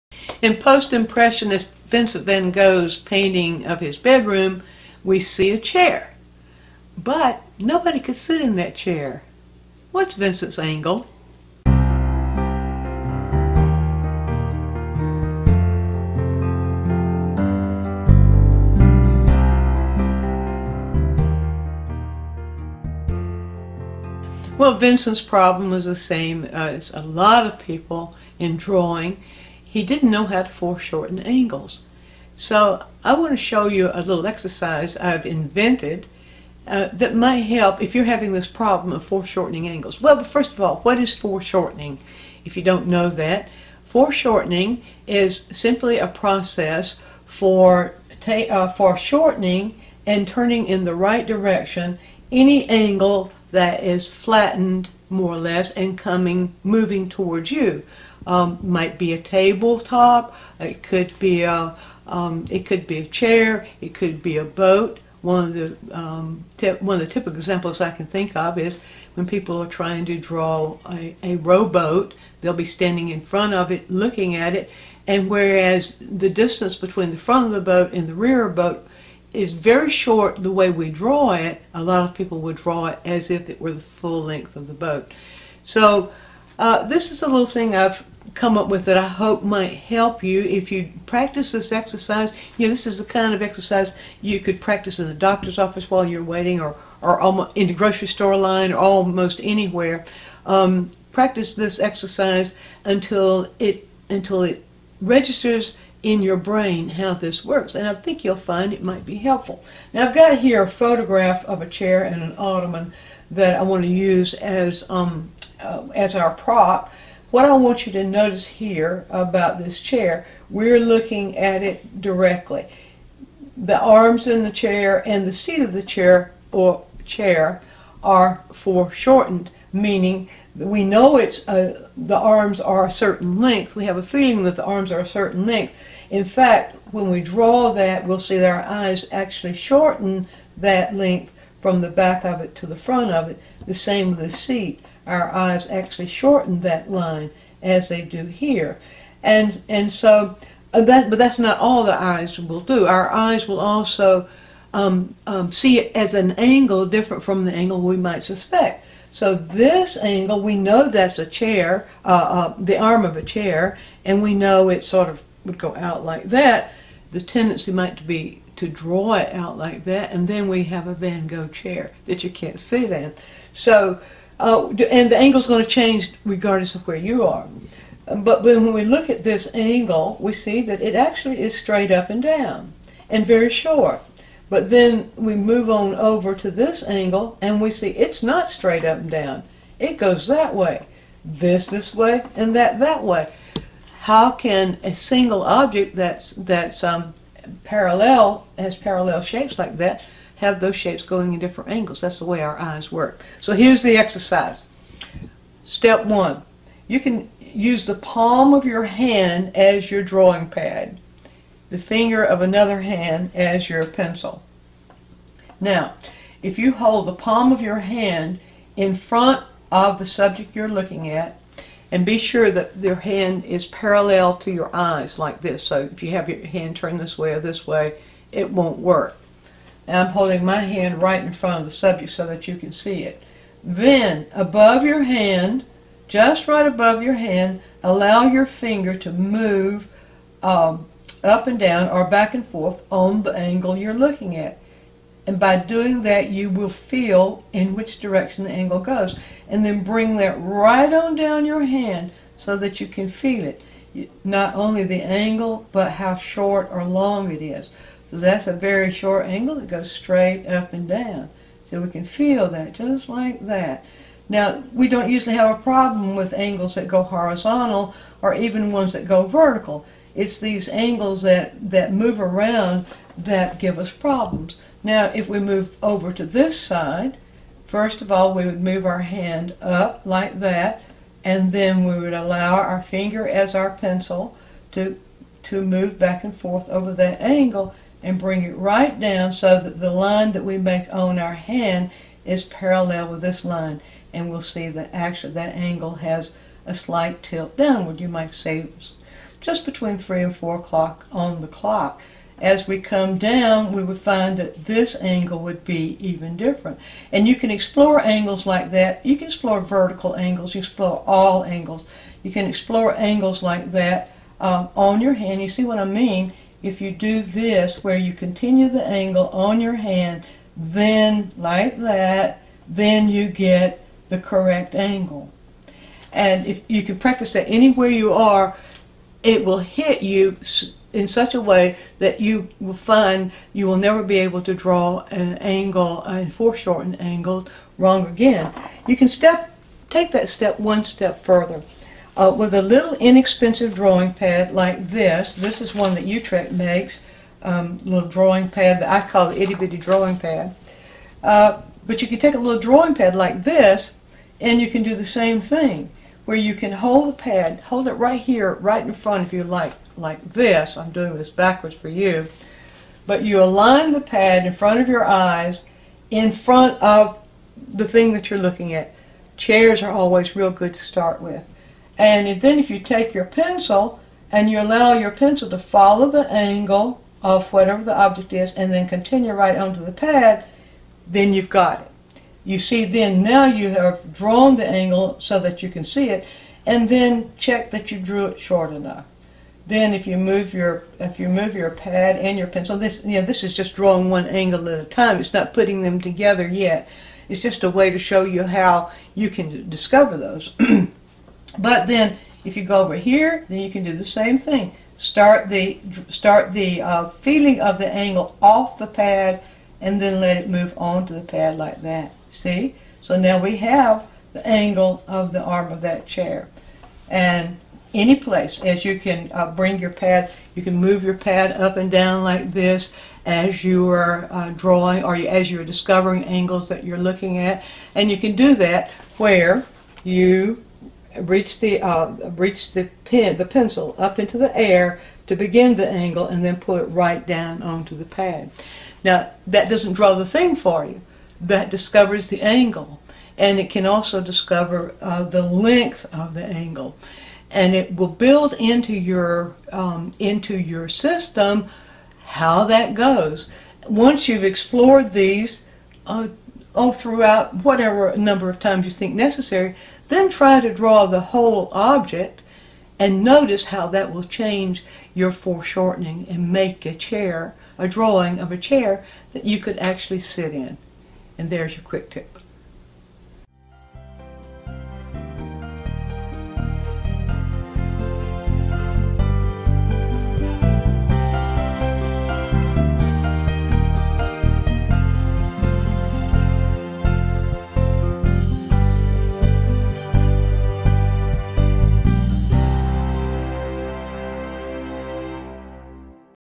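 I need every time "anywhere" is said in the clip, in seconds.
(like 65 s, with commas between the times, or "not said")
99 s, 327 s.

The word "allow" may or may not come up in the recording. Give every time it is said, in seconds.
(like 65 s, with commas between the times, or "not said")
237 s, 282 s, 374 s.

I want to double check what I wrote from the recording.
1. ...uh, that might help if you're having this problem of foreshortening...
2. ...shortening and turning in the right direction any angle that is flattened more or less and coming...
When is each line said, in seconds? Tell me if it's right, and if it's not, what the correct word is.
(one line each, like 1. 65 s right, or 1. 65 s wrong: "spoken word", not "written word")
1. 36 s right
2. 48 s right.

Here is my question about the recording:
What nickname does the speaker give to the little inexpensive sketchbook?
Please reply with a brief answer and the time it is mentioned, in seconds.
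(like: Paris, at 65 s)
itty bitty drawing pad, at 349 s.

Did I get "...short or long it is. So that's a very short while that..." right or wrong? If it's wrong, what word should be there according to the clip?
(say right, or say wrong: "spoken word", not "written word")
wrong: "angle", not "while".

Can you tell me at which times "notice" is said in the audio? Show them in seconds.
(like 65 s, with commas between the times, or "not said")
118 s, 463 s.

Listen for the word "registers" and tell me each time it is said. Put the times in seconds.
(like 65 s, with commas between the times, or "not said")
105 s.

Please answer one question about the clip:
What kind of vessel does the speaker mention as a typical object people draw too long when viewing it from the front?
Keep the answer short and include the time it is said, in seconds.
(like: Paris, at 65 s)
rowboat, at 71 s.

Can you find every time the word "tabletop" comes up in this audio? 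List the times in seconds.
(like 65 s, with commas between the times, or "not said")
59 s.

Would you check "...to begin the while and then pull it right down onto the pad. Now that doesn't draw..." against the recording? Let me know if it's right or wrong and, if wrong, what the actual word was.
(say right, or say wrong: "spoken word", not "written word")
wrong: "angle", not "while".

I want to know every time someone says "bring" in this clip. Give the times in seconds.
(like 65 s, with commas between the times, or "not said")
249 s, 288 s, 419 s.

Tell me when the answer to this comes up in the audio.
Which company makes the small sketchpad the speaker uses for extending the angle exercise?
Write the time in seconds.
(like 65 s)
346 s.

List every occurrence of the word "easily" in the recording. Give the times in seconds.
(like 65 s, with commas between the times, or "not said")
not said.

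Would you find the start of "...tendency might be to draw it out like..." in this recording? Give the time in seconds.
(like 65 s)
167 s.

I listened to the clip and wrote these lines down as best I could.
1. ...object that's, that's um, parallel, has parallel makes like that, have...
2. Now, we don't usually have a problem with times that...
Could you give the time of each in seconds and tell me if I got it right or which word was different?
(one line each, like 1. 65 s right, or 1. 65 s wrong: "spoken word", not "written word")
1. 195 s wrong: "shapes", not "makes"
2. 264 s wrong: "angles", not "times".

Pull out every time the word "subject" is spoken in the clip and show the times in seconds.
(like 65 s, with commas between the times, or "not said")
220 s, 231 s.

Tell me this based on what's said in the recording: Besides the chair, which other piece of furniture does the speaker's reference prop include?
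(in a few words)
ottoman.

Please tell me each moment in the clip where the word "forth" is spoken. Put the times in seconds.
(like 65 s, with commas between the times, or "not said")
242 s, 286 s.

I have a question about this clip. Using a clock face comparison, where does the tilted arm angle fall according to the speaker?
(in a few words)
between 3 and 4 o'clock.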